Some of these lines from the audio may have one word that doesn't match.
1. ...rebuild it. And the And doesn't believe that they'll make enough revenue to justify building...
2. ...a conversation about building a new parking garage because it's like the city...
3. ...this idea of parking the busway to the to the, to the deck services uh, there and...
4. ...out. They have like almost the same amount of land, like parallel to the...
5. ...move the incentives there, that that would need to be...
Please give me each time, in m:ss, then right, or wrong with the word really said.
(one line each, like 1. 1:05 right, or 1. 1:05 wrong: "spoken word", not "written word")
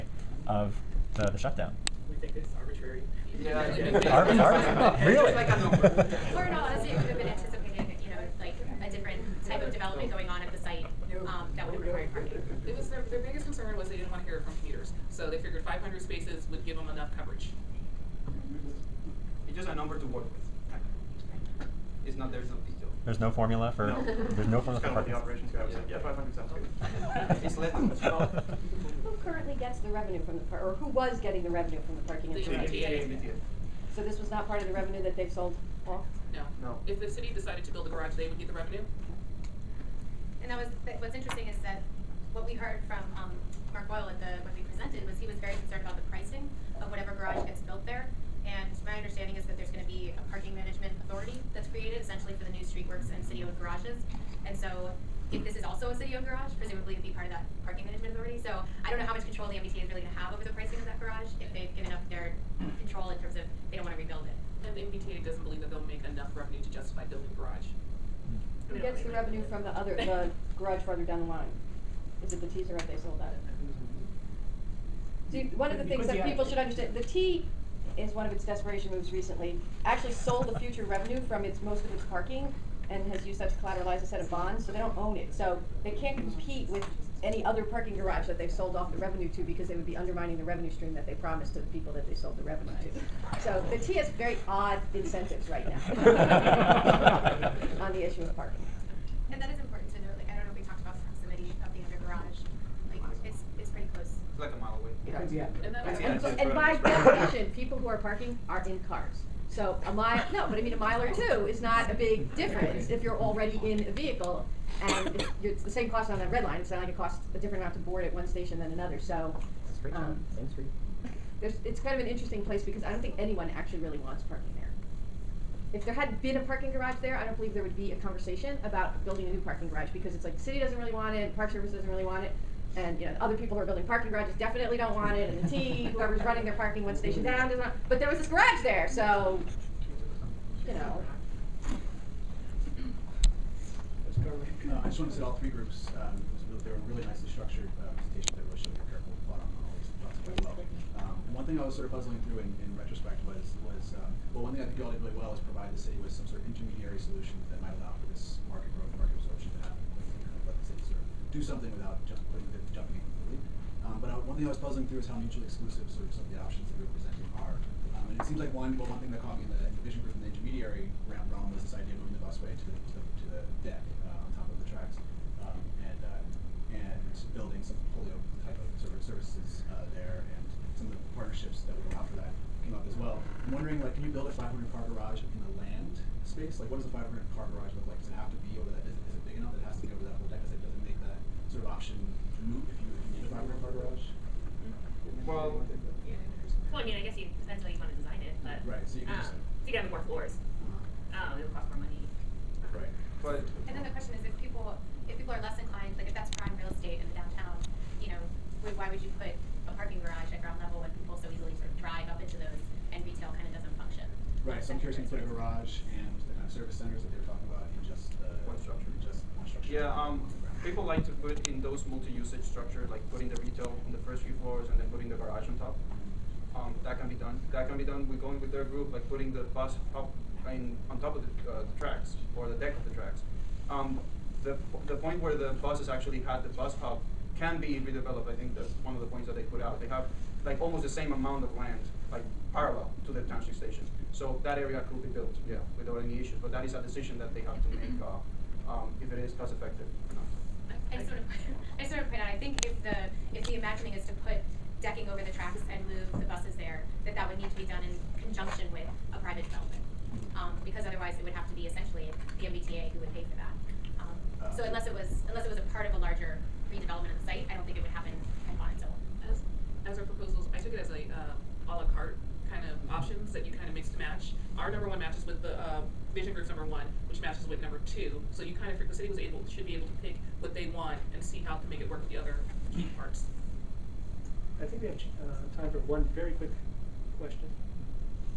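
1. 1:03 wrong: "MBTA", not "And"
2. 2:07 right
3. 2:51 wrong: "moving", not "parking"
4. 3:59 right
5. 4:15 wrong: "buses", not "incentives".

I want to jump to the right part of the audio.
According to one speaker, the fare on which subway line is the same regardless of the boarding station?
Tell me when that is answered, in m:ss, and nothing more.
1:56.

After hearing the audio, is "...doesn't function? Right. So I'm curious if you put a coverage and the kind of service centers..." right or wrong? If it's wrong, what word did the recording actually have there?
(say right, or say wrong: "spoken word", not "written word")
wrong: "garage", not "coverage".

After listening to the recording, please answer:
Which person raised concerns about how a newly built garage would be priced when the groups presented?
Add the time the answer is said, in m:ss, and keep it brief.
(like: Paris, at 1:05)
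Mark Boyle, at 0:43.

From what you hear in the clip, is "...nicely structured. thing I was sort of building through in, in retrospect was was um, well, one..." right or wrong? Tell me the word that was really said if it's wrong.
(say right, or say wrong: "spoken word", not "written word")
wrong: "puzzling", not "building".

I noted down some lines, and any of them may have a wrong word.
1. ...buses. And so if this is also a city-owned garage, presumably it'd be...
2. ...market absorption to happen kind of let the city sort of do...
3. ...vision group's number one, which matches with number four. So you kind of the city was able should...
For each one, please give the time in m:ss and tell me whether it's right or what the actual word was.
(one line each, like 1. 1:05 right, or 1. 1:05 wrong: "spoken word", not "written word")
1. 0:53 wrong: "garages", not "buses"
2. 2:39 right
3. 4:36 wrong: "two", not "four".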